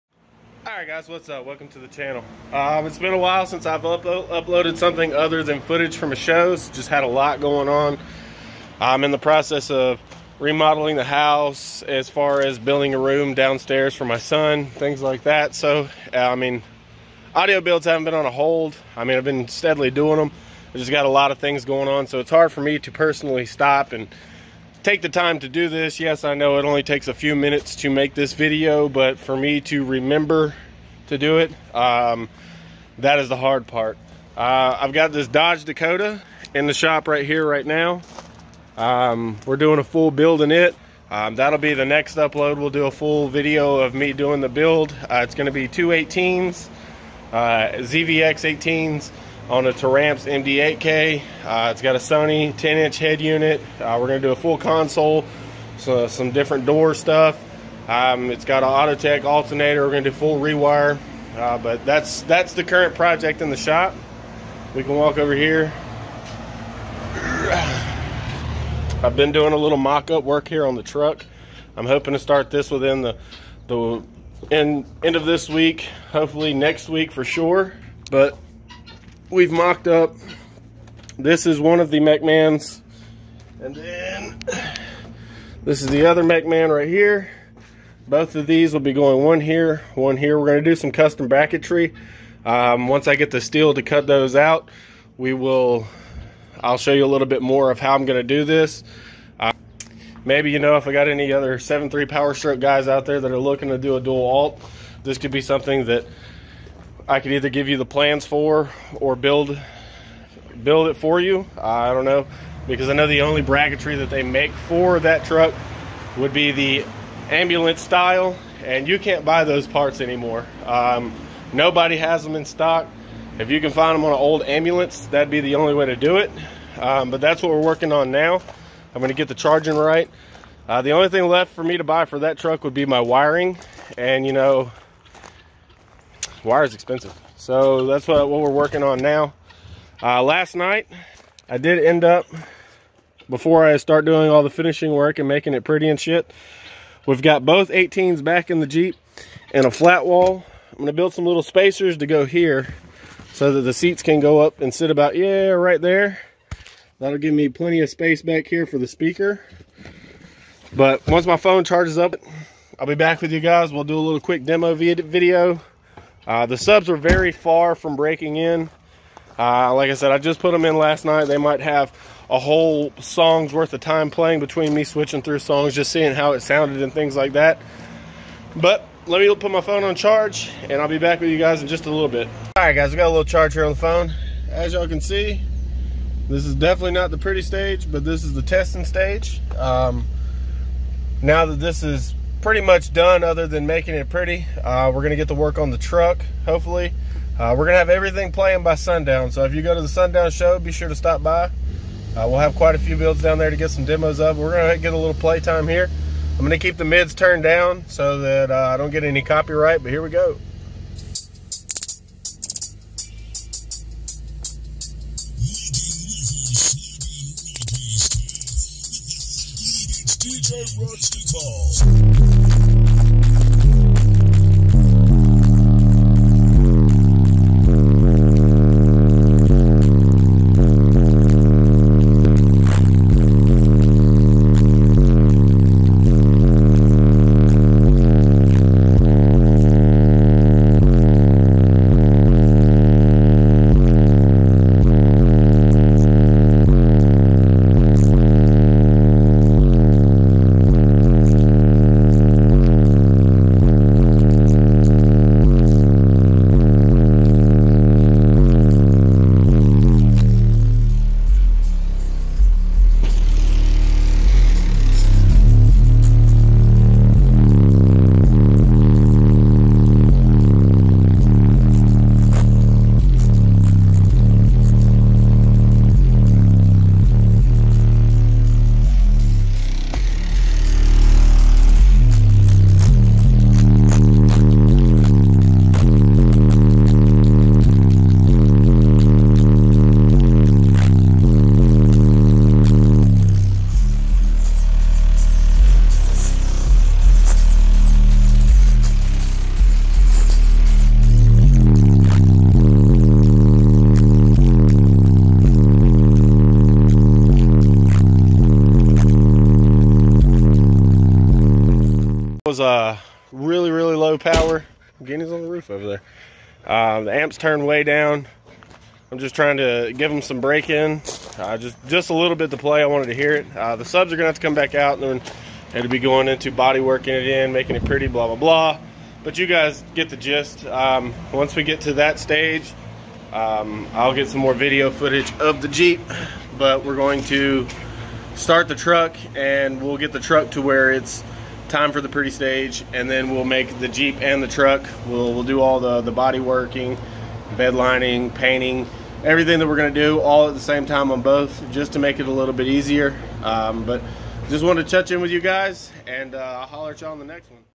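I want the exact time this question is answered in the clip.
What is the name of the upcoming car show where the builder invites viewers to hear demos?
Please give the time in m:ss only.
3:19.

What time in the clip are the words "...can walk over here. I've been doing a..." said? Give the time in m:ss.
1:04.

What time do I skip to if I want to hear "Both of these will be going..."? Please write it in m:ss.
1:28.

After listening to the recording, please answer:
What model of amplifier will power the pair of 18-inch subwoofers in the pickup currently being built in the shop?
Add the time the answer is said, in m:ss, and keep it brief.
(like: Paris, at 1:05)
Taramps MD8K, at 0:49.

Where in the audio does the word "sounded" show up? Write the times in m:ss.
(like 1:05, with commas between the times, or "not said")
2:56.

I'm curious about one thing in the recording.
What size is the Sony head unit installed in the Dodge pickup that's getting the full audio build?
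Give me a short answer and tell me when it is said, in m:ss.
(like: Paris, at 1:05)
10 inch, at 0:52.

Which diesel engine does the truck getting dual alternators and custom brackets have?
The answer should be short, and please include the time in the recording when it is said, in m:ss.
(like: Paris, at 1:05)
7.3 Power Stroke, at 1:41.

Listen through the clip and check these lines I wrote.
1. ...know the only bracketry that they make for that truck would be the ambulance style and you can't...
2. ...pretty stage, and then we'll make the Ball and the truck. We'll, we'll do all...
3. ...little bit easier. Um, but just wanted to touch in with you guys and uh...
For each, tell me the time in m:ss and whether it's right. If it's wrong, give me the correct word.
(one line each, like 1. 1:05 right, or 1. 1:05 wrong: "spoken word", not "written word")
1. 1:52 right
2. 5:42 wrong: "Jeep", not "Ball"
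3. 5:52 right.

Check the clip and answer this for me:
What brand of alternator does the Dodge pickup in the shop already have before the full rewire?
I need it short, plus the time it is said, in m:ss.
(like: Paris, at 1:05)
Autotech, at 0:58.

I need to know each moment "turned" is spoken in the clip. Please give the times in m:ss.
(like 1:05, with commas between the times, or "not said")
3:27, 5:17.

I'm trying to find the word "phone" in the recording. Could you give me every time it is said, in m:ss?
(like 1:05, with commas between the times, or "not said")
2:41, 2:59, 3:03.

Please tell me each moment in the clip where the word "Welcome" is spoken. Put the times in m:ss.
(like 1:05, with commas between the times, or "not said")
0:01.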